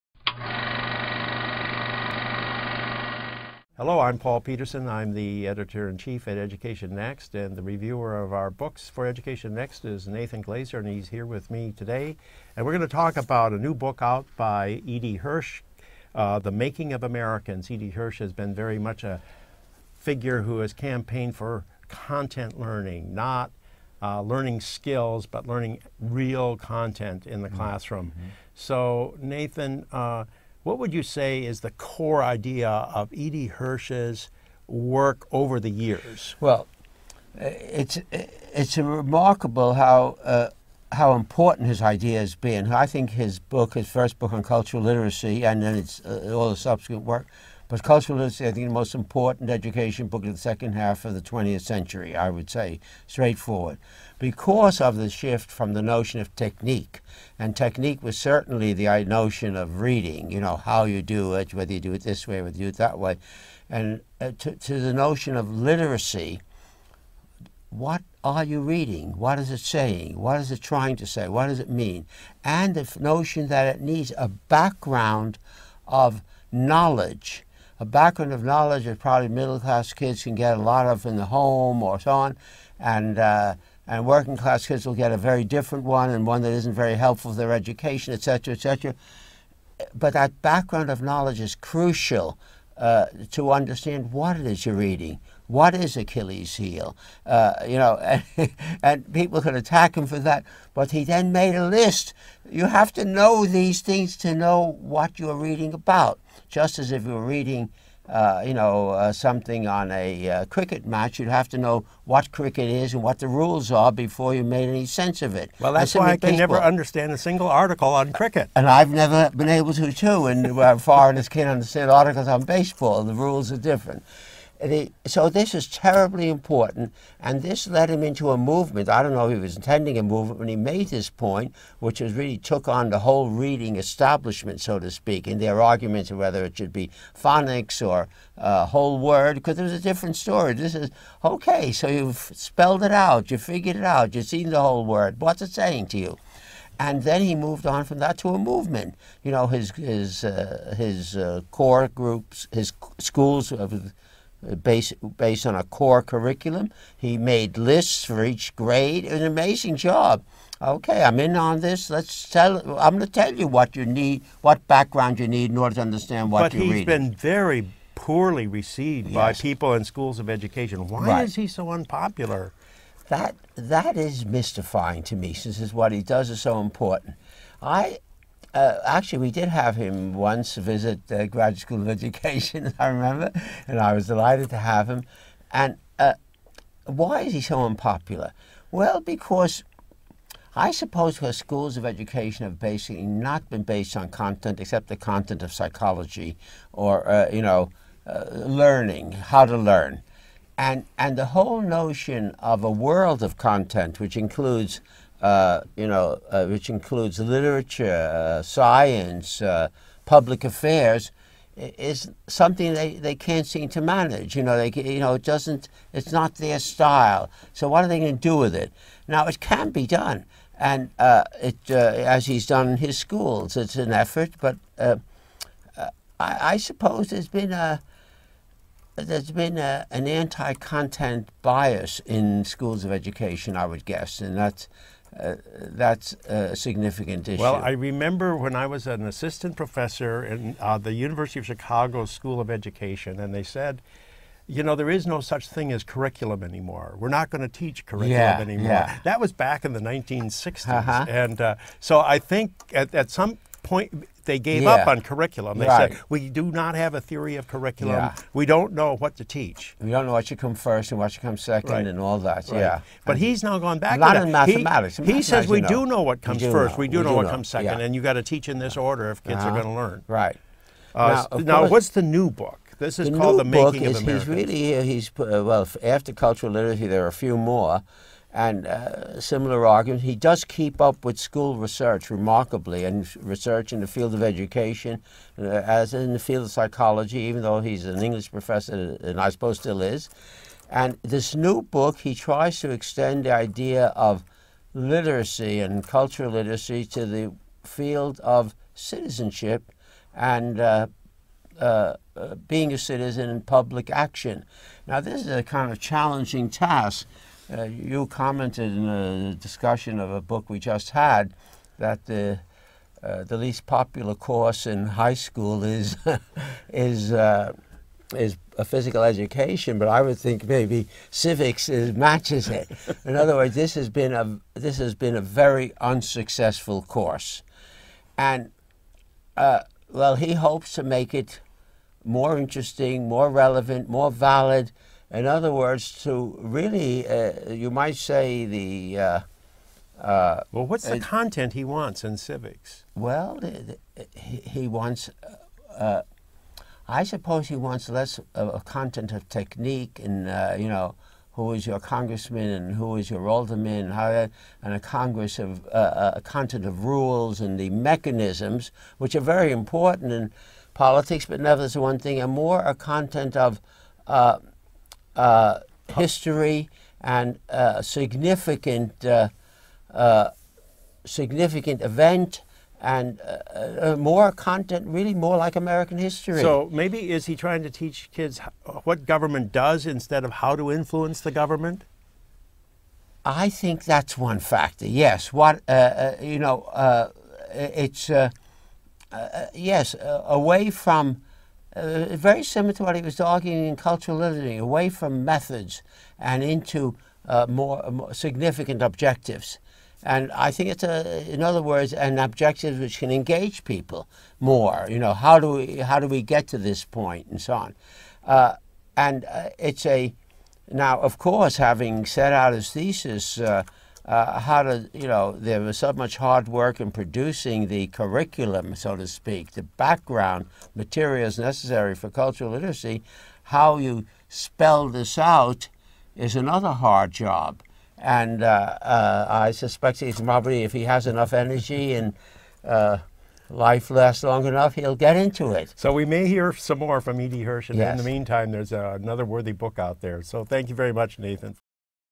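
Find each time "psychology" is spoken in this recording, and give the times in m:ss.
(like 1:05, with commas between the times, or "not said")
3:15, 4:46.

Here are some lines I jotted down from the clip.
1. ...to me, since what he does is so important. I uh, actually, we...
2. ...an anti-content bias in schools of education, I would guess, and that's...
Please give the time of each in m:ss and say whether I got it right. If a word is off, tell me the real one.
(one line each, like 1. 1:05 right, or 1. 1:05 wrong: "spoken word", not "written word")
1. 2:55 right
2. 3:49 right.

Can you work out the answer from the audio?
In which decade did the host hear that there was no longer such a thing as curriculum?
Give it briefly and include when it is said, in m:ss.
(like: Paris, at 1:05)
1960s, at 4:09.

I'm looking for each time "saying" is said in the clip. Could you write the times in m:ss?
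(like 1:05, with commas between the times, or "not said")
1:09, 2:25.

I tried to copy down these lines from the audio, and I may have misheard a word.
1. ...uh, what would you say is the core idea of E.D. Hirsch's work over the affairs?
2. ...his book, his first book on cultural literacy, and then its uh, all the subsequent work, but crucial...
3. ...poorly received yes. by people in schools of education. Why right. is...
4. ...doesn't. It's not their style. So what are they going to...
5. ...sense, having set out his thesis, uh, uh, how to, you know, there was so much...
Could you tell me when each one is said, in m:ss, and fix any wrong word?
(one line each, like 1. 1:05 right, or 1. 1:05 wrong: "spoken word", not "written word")
1. 0:29 wrong: "years", not "affairs"
2. 0:43 wrong: "cultural", not "crucial"
3. 2:47 right
4. 3:35 right
5. 6:51 wrong: "course", not "sense".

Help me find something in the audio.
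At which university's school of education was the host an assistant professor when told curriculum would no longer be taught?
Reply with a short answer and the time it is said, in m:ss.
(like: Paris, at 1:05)
University of Chicago, at 4:00.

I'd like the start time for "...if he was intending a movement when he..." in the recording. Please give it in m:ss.
2:09.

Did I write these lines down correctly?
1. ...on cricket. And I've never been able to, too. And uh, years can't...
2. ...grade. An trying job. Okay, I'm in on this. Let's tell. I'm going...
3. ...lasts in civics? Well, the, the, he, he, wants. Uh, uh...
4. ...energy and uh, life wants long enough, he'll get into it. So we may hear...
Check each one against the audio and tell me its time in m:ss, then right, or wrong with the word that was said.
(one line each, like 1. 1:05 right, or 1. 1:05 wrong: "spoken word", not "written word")
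1. 1:57 wrong: "foreigners", not "years"
2. 2:38 wrong: "amazing", not "trying"
3. 5:41 wrong: "wants", not "lasts"
4. 7:11 wrong: "lasts", not "wants".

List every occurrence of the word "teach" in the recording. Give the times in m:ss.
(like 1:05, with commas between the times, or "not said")
4:07, 4:19, 4:28, 6:17.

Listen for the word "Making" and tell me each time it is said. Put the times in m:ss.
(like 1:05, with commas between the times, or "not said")
0:16, 4:33.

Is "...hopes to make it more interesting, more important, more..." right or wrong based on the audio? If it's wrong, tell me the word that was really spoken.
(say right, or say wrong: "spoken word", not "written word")
wrong: "relevant", not "important".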